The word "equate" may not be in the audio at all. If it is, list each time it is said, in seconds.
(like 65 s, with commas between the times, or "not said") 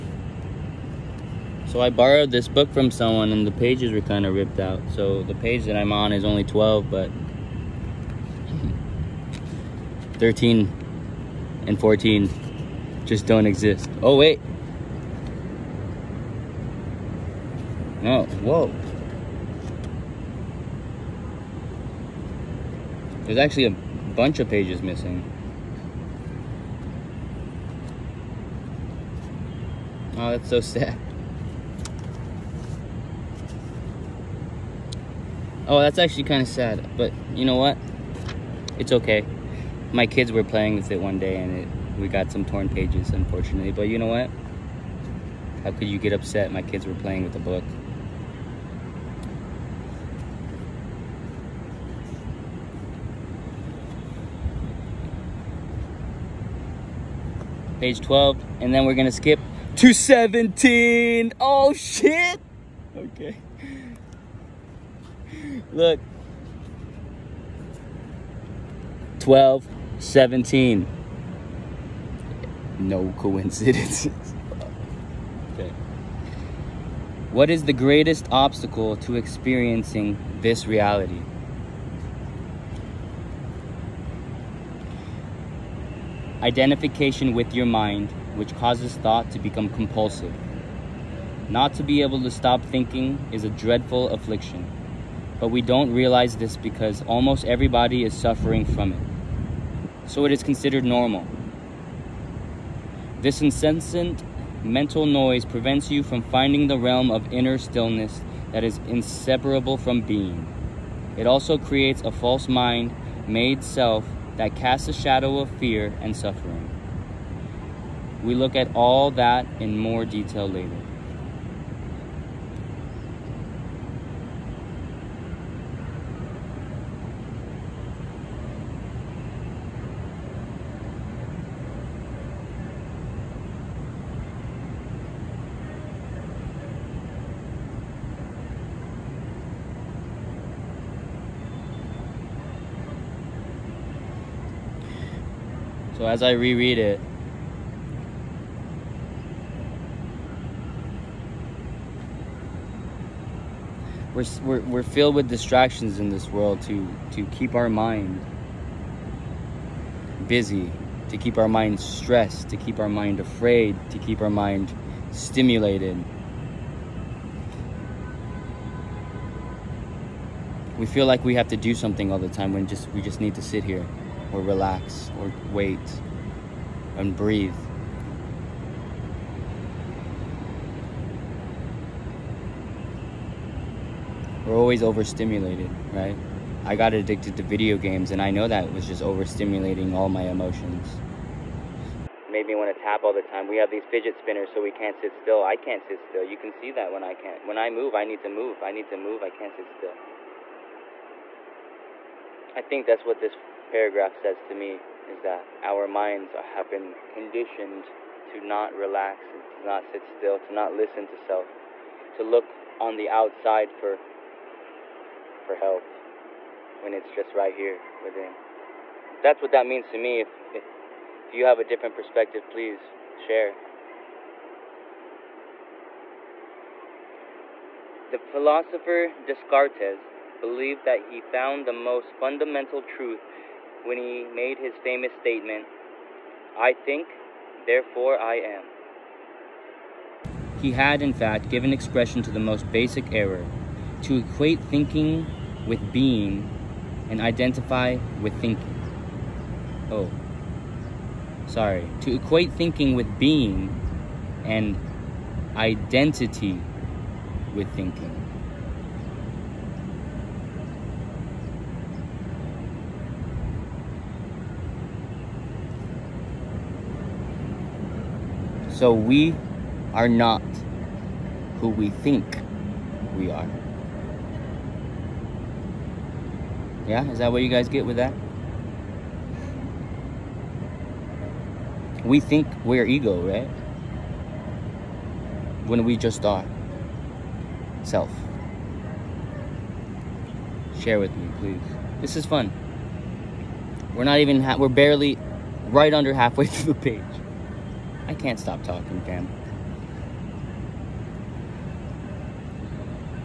244 s, 252 s.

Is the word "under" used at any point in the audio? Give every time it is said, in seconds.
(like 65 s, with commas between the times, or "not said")
295 s.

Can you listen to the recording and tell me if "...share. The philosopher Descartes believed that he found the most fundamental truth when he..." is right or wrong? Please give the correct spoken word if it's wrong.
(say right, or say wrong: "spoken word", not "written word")
right.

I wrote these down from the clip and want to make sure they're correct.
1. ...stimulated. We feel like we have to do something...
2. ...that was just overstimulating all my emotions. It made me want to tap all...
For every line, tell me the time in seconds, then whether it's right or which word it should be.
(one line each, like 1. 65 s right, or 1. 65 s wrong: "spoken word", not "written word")
1. 165 s right
2. 188 s right.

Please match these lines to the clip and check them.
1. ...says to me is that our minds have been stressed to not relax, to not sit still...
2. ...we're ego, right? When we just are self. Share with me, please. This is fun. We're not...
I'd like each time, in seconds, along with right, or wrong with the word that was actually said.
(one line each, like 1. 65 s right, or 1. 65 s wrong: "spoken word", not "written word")
1. 204 s wrong: "conditioned", not "stressed"
2. 282 s right.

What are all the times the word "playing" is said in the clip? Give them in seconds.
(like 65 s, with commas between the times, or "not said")
40 s, 46 s.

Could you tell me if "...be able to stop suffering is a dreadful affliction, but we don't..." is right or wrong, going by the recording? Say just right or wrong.
wrong.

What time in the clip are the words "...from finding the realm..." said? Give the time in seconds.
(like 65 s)
106 s.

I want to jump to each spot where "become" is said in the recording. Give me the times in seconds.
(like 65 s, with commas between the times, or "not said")
89 s.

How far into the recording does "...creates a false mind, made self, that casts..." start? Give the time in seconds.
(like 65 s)
111 s.